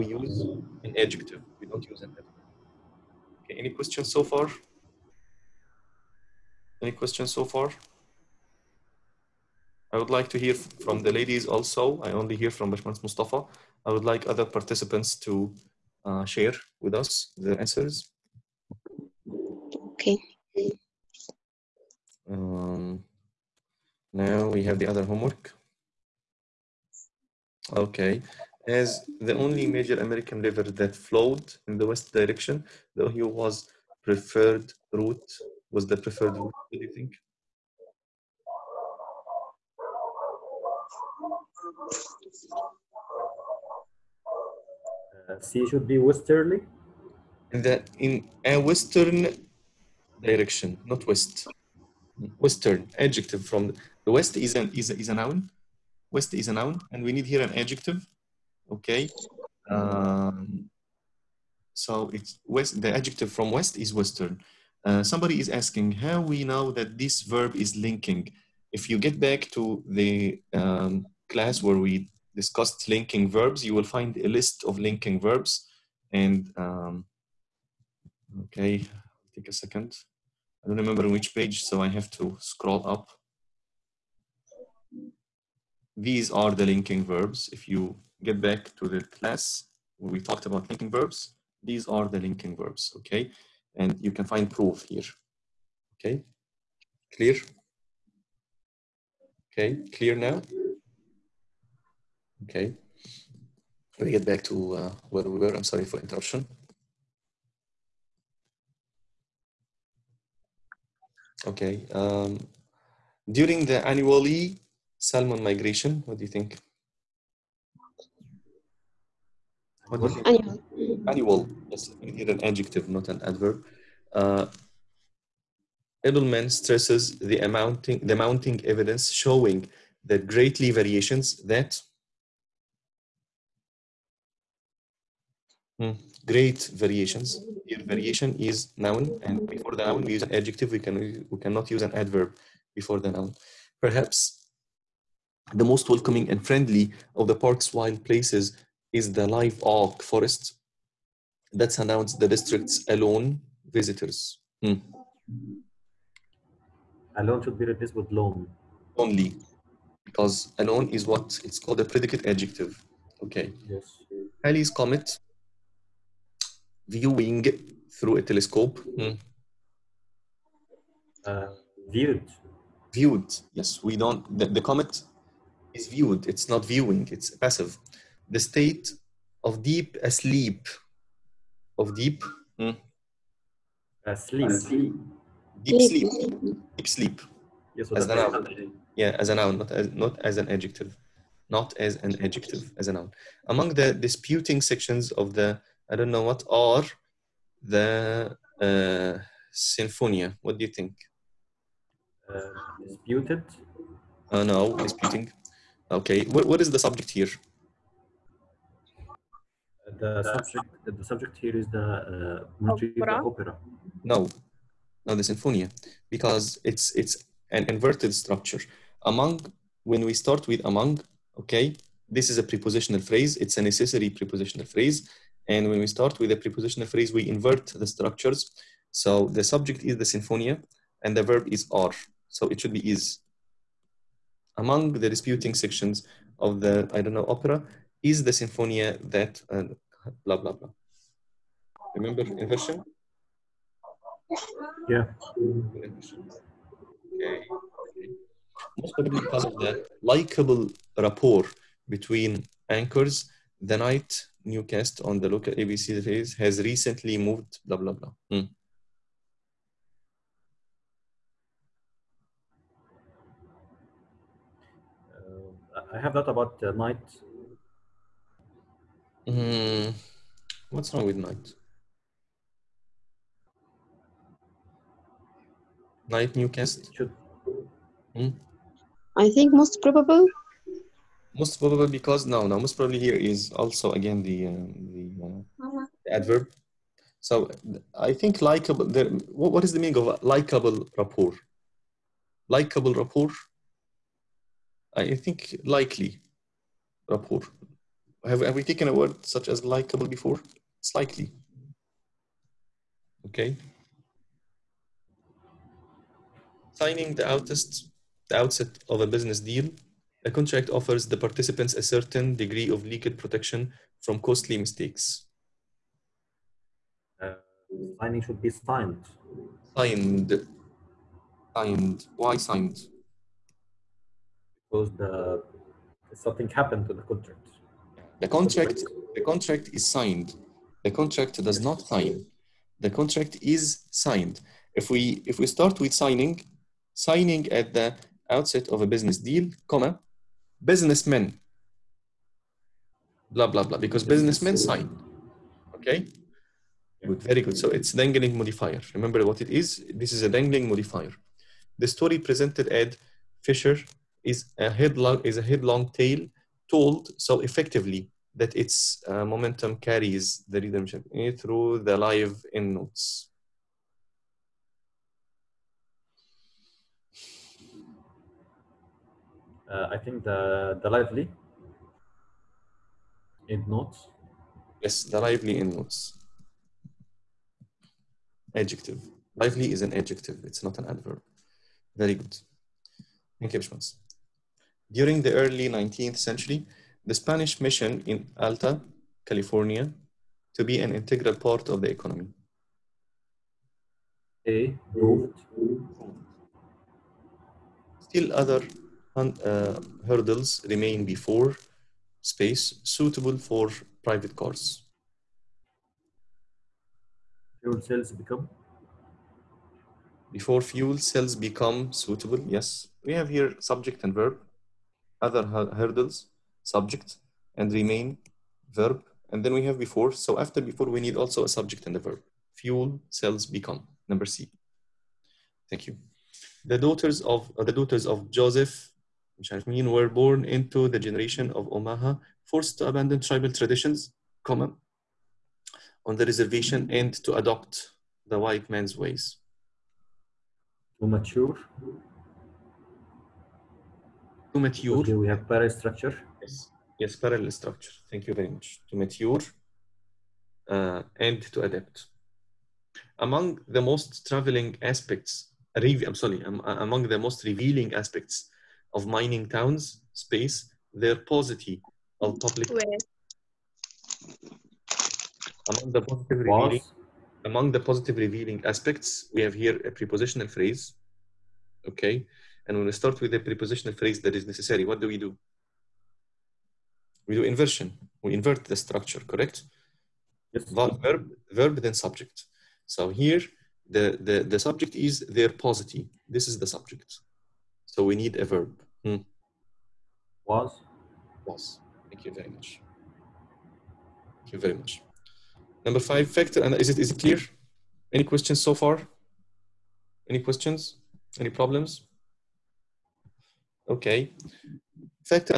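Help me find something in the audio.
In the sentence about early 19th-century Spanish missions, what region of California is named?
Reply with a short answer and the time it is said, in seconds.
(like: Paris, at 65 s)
Alta, at 388 s.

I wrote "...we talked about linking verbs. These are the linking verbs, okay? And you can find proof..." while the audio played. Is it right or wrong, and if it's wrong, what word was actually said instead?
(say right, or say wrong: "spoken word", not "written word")
right.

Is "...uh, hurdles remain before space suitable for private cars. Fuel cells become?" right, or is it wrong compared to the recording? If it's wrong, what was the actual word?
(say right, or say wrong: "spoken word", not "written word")
right.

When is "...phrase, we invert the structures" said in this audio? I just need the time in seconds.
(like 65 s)
226 s.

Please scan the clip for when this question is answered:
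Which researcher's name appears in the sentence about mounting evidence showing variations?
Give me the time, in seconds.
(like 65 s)
126 s.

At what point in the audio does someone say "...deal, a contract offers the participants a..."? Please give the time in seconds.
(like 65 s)
309 s.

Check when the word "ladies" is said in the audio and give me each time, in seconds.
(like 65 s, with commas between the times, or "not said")
11 s.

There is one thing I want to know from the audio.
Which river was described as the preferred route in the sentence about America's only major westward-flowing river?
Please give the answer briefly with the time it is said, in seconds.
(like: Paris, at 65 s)
Ohio, at 32 s.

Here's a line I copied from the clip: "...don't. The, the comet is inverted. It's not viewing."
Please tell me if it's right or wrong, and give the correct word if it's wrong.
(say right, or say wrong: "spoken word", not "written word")
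wrong: "viewed", not "inverted".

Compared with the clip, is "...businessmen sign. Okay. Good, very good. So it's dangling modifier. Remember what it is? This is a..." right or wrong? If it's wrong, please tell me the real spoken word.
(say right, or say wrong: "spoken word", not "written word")
right.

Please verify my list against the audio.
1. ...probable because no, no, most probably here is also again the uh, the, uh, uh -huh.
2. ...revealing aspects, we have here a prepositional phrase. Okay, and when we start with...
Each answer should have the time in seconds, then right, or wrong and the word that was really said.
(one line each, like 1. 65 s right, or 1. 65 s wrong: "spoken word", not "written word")
1. 281 s right
2. 468 s right.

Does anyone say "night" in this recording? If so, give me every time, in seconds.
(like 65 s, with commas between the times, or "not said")
253 s, 266 s, 271 s, 276 s.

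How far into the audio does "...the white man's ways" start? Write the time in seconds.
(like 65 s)
438 s.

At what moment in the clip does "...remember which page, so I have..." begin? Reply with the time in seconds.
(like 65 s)
80 s.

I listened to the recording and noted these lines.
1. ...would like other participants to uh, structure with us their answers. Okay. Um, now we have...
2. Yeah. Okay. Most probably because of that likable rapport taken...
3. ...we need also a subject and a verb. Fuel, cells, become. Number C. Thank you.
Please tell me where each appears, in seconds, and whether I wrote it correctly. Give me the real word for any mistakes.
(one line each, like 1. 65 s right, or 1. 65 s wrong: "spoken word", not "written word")
1. 13 s wrong: "share", not "structure"
2. 244 s wrong: "between", not "taken"
3. 420 s right.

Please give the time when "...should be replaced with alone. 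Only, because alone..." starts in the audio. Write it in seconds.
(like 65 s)
157 s.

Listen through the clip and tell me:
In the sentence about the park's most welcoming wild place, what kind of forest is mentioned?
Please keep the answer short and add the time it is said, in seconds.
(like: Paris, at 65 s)
live oak forest, at 149 s.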